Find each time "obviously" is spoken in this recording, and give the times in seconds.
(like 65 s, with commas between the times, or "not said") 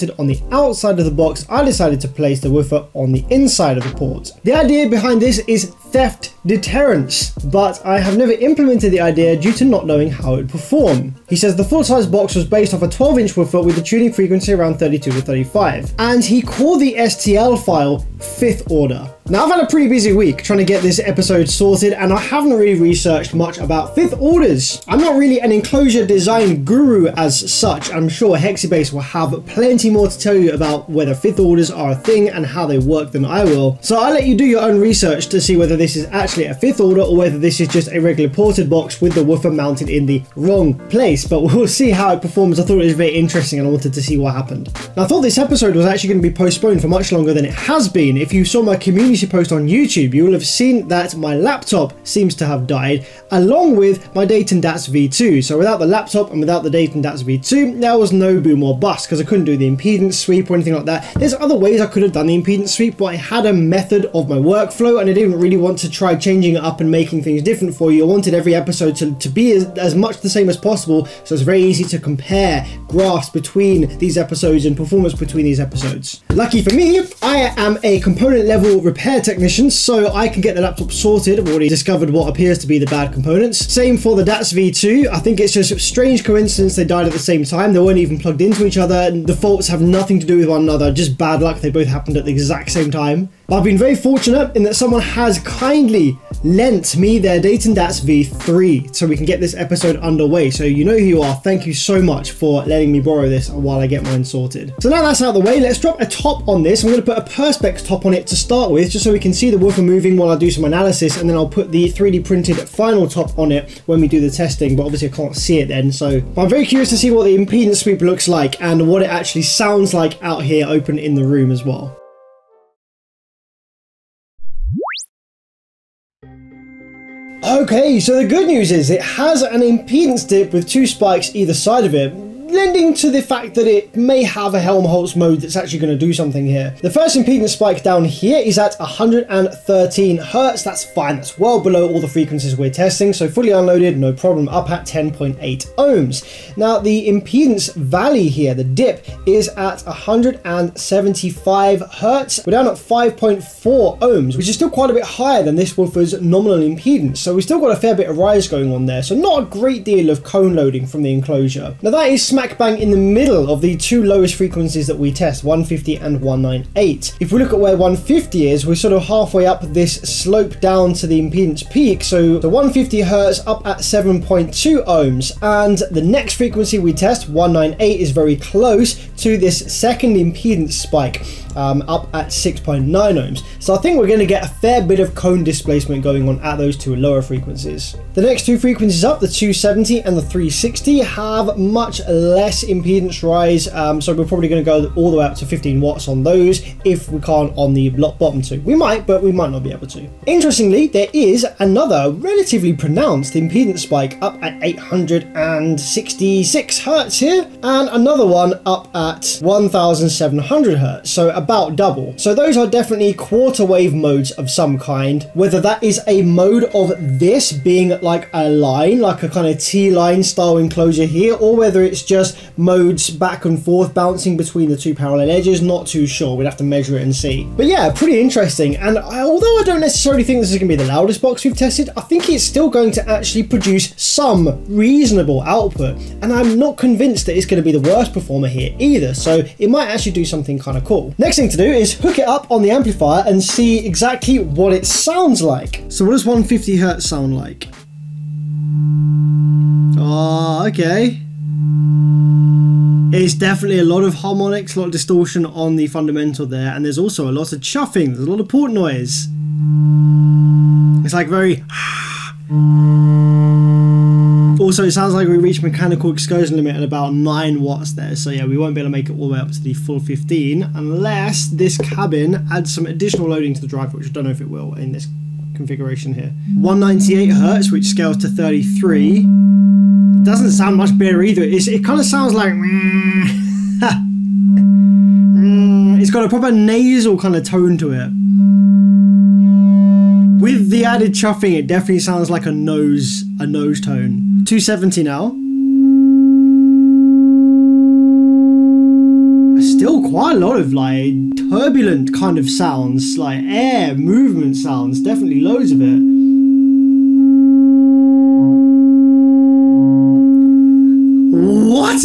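114 s.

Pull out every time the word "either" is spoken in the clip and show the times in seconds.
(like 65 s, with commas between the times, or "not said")
131 s, 238 s, 281 s.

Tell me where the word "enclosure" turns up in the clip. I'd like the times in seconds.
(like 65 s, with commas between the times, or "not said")
25 s, 161 s, 220 s.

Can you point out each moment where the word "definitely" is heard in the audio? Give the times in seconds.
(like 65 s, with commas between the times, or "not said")
212 s, 253 s, 291 s, 304 s.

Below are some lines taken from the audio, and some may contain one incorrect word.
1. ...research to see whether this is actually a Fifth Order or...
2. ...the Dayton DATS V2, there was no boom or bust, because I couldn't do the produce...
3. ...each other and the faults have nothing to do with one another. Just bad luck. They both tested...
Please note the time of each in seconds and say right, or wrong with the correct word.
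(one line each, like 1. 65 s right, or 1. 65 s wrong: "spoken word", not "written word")
1. 34 s right
2. 56 s wrong: "impedance", not "produce"
3. 88 s wrong: "happened", not "tested".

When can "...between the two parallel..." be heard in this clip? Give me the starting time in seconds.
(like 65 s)
224 s.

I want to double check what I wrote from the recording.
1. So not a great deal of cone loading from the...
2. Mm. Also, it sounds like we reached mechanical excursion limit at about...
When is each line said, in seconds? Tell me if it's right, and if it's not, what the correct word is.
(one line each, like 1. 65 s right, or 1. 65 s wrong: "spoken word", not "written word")
1. 159 s right
2. 264 s right.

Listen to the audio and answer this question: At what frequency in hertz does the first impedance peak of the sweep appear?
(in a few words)
113 Hz.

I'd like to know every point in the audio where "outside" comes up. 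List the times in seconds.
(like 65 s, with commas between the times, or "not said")
0 s.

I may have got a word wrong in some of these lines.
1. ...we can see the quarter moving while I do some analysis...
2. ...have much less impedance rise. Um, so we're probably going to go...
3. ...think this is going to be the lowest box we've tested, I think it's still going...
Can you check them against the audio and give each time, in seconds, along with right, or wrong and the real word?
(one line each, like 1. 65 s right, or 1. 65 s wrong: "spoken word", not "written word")
1. 109 s wrong: "woofer", not "quarter"
2. 190 s right
3. 230 s wrong: "loudest", not "lowest".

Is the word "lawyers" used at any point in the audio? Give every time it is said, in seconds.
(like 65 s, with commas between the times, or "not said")
not said.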